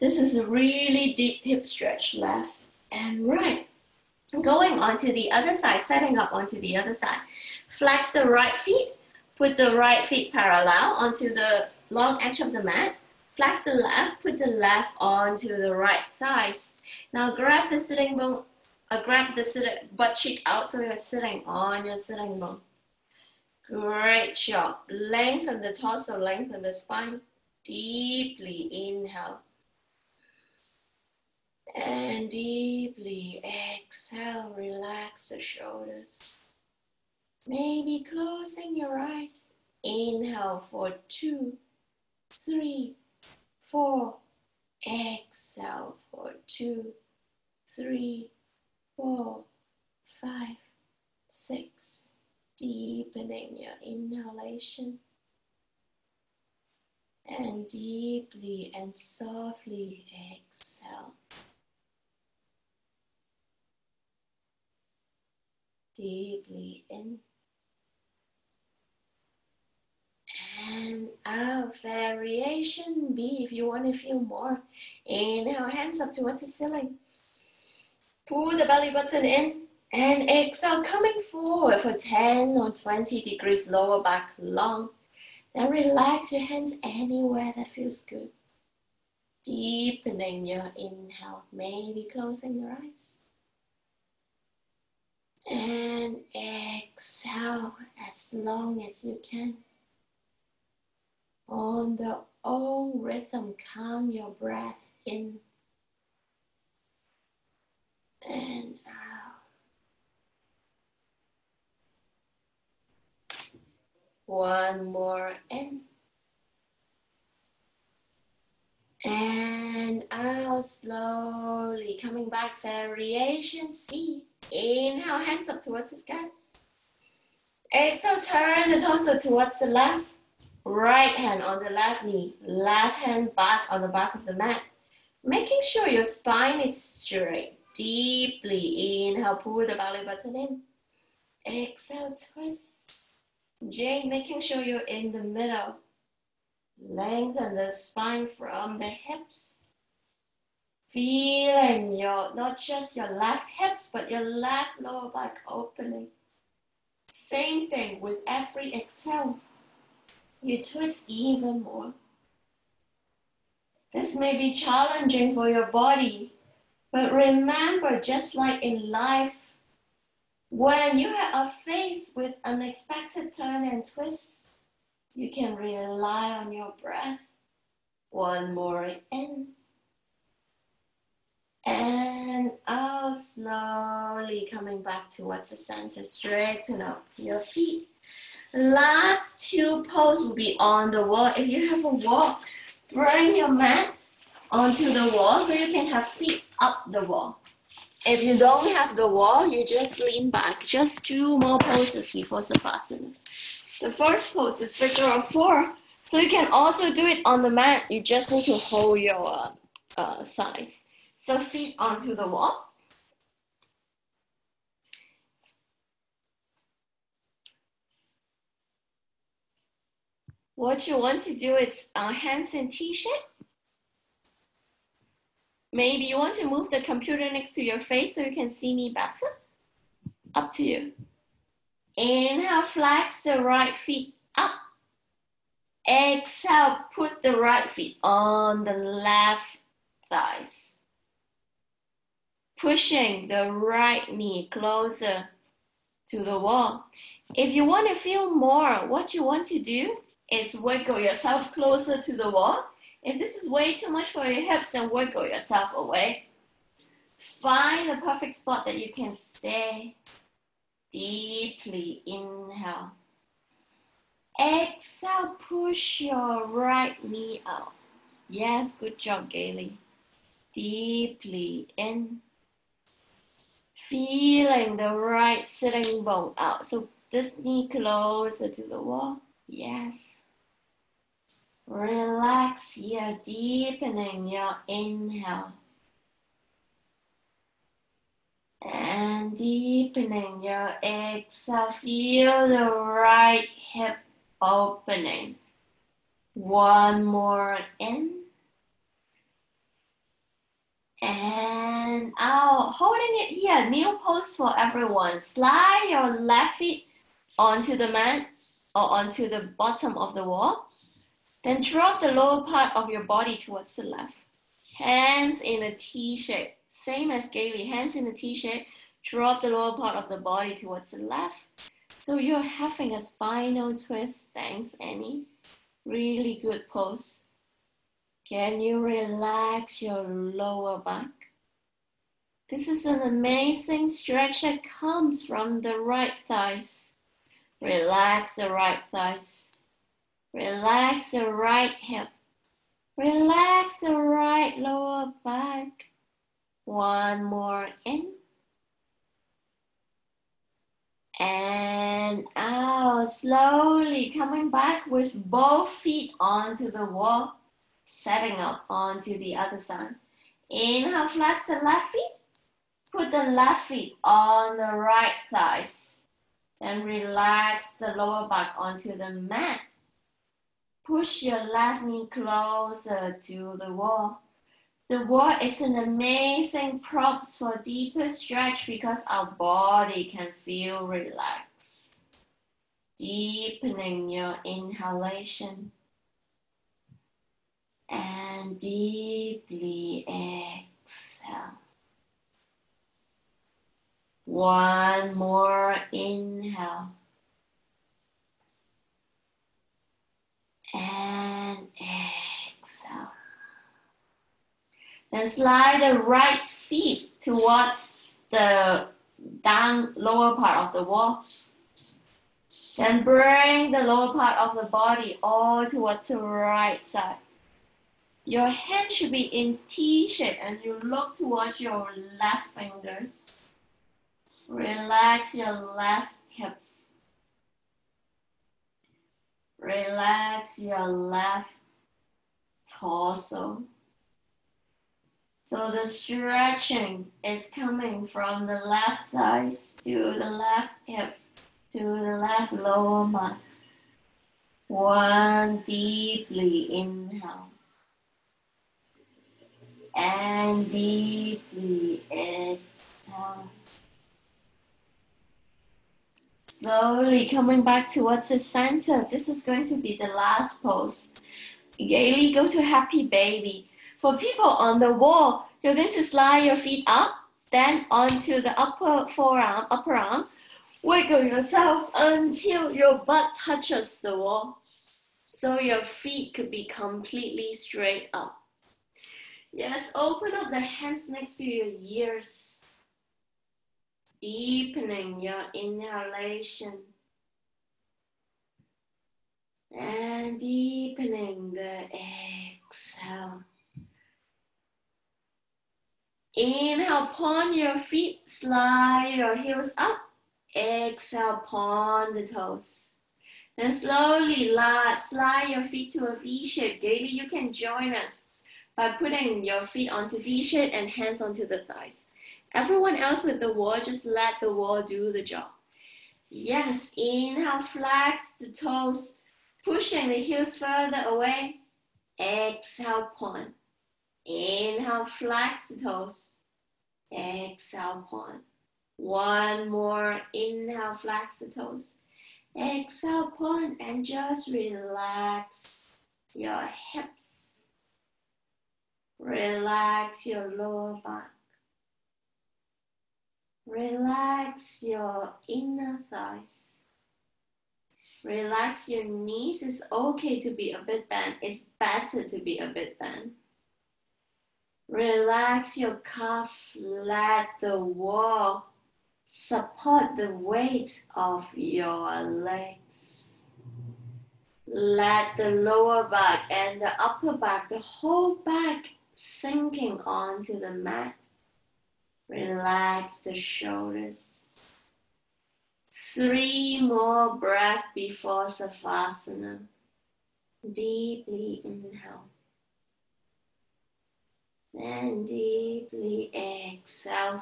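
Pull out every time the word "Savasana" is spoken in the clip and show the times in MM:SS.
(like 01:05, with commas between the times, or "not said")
03:22, 09:38.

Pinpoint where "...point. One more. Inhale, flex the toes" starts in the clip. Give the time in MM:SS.
08:48.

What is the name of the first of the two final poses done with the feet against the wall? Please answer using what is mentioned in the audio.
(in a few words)
Figure of four.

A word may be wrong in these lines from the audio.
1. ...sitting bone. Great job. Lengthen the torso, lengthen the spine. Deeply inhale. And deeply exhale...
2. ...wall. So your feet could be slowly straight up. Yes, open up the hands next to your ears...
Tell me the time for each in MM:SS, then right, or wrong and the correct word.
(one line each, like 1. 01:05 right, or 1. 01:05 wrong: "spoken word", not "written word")
1. 00:21 right
2. 07:54 wrong: "completely", not "slowly".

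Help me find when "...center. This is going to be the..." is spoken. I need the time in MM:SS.
07:38.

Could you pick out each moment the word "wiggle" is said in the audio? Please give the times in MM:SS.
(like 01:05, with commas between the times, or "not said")
04:10, 04:14, 07:50.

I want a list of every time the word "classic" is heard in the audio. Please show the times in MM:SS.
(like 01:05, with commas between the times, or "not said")
not said.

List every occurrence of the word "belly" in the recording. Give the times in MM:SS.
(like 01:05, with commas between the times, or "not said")
01:18, 02:19.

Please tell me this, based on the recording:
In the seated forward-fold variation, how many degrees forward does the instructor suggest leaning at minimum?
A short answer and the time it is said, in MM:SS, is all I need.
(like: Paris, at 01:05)
10, at 01:21.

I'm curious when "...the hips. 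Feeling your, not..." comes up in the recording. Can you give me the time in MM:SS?
02:28.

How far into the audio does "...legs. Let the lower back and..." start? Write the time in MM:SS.
09:22.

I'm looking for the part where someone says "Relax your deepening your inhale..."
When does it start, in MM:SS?
04:41.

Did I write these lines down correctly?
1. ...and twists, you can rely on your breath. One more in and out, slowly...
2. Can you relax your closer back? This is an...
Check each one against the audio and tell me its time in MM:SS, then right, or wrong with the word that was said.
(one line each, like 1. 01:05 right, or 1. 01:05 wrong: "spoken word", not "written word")
1. 02:53 right
2. 05:28 wrong: "lower", not "closer".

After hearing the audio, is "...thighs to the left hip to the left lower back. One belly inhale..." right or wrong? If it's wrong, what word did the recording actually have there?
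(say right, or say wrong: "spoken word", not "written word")
wrong: "deeply", not "belly".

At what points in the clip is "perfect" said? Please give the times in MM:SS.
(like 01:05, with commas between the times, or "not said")
04:17.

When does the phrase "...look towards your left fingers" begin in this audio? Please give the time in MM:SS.
07:00.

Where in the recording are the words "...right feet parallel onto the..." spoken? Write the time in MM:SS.
00:09.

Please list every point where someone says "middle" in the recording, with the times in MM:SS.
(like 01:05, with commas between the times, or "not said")
02:25.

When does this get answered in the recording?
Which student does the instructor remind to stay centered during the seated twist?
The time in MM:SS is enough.
02:23.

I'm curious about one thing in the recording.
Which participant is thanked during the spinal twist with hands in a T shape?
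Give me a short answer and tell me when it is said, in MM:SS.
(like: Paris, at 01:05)
Annie, at 05:24.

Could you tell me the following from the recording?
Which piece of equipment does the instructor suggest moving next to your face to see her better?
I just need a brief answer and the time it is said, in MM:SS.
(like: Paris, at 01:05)
Computer, at 03:46.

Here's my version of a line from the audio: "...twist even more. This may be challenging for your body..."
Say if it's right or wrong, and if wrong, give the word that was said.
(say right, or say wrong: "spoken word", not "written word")
right.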